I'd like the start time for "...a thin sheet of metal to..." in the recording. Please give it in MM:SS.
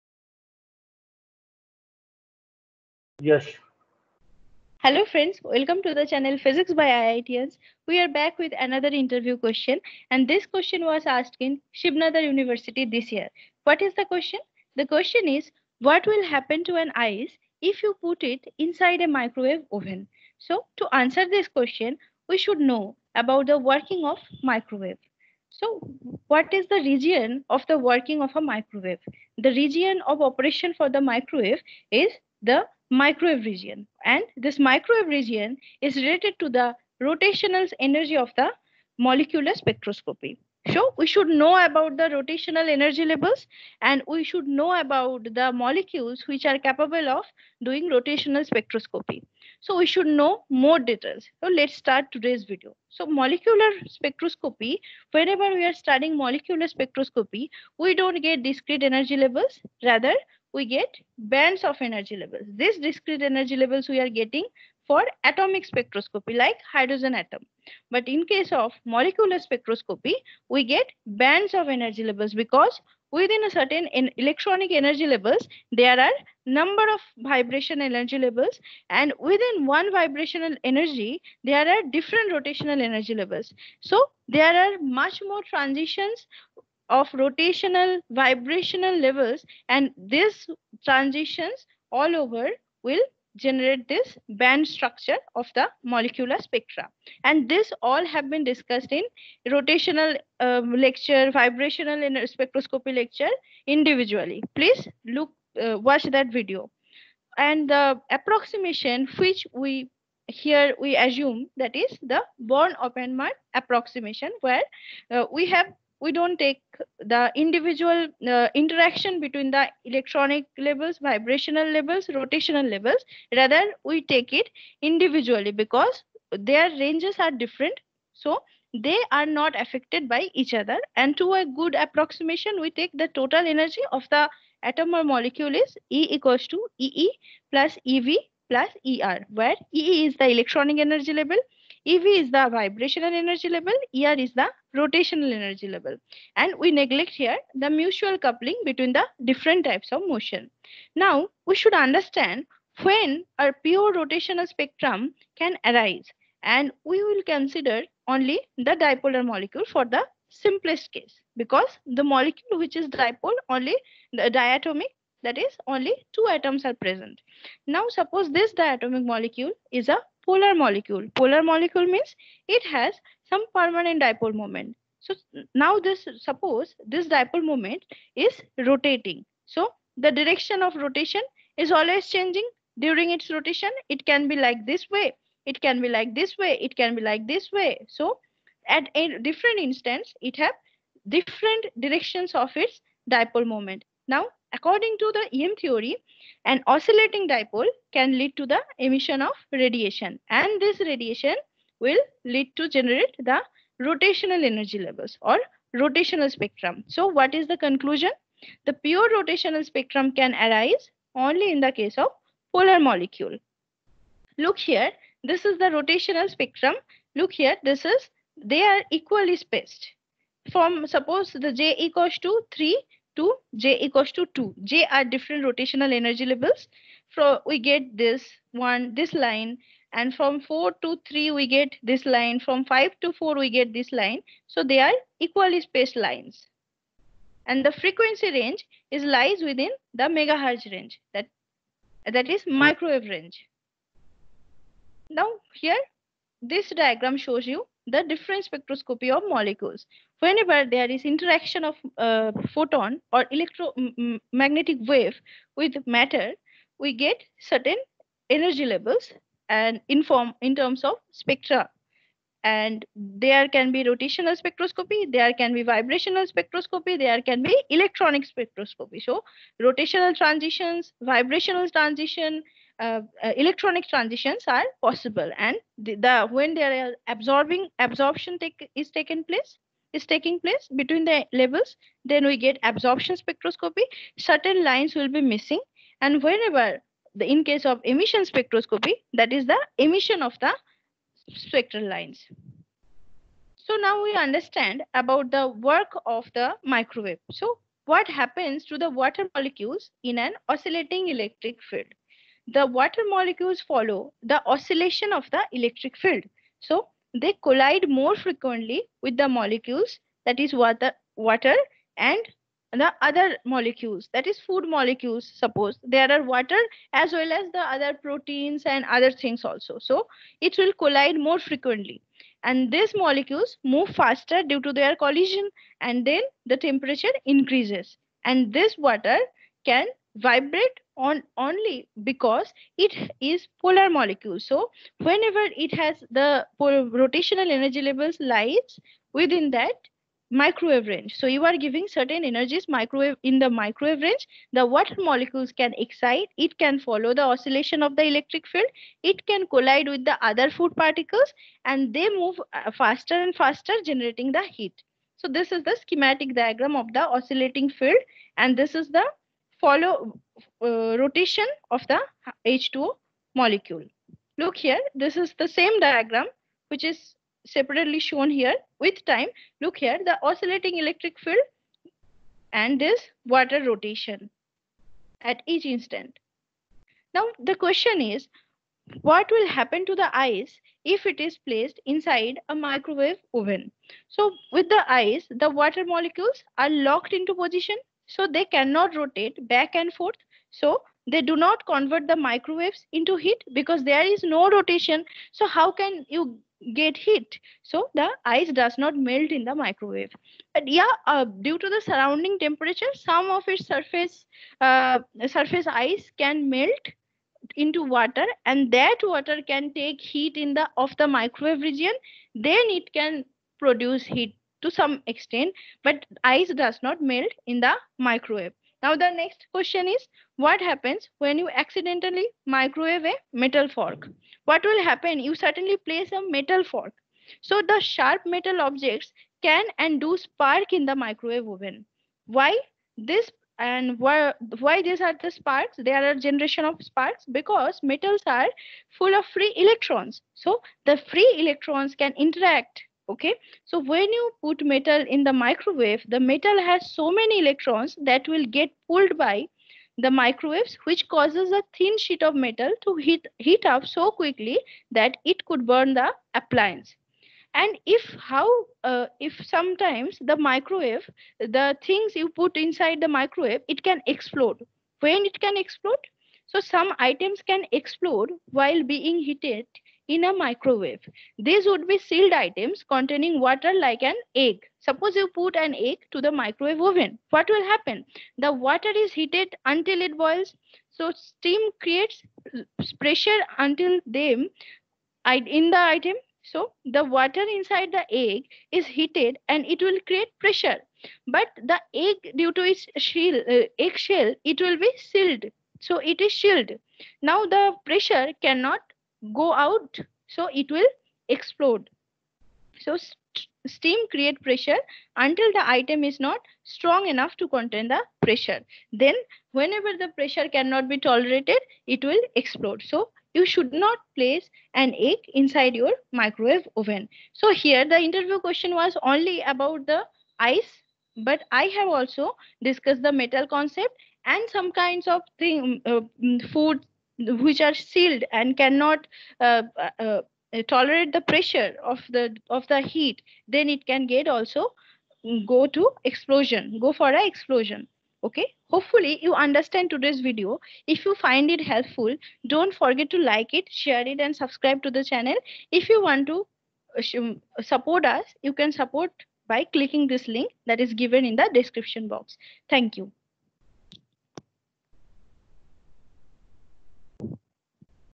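07:31.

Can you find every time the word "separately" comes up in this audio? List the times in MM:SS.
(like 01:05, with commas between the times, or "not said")
06:07.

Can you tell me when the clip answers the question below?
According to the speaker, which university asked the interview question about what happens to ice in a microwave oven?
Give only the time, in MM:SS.
00:11.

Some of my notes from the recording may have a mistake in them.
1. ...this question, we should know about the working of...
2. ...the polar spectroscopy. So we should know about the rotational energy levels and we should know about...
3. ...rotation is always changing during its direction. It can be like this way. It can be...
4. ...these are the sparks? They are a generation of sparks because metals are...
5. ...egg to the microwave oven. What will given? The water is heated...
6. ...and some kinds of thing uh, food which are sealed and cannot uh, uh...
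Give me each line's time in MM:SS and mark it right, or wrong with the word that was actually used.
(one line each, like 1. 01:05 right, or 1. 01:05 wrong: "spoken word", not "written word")
1. 00:21 right
2. 00:38 wrong: "molecular", not "polar"
3. 03:00 wrong: "rotation", not "direction"
4. 07:14 right
5. 07:55 wrong: "happen", not "given"
6. 08:44 right.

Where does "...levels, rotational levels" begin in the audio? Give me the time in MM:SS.
02:01.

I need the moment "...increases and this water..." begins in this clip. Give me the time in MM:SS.
05:27.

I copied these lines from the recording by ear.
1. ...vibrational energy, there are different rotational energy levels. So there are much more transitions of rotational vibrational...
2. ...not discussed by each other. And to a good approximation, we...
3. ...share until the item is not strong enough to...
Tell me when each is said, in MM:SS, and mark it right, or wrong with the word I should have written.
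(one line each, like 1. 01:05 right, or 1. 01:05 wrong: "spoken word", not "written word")
1. 01:19 right
2. 02:09 wrong: "affected", not "discussed"
3. 08:24 wrong: "pressure", not "share".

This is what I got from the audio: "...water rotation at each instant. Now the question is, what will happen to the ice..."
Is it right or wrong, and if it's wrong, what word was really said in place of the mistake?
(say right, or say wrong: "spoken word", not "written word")
right.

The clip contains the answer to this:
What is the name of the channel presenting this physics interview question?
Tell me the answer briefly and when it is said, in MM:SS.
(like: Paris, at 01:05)
Physics by IITians, at 00:06.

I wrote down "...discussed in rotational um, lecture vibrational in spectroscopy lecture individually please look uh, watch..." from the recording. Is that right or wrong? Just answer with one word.
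right.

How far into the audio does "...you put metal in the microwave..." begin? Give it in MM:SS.
07:24.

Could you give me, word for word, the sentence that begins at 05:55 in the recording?
So this is the schematic diagram of the oscillating field and this is the follow uh, rotation of the H2O molecule.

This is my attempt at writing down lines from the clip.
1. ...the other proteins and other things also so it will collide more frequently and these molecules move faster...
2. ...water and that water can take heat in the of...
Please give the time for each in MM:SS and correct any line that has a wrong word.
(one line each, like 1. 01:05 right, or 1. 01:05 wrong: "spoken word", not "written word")
1. 05:17 right
2. 06:47 right.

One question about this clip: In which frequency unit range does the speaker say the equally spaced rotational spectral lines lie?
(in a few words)
megahertz.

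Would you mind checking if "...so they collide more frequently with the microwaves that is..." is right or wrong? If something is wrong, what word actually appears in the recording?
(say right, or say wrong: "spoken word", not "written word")
wrong: "molecules", not "microwaves".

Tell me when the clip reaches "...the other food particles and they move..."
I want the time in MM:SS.
05:50.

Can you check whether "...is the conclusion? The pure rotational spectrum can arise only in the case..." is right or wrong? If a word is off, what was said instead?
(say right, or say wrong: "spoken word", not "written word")
right.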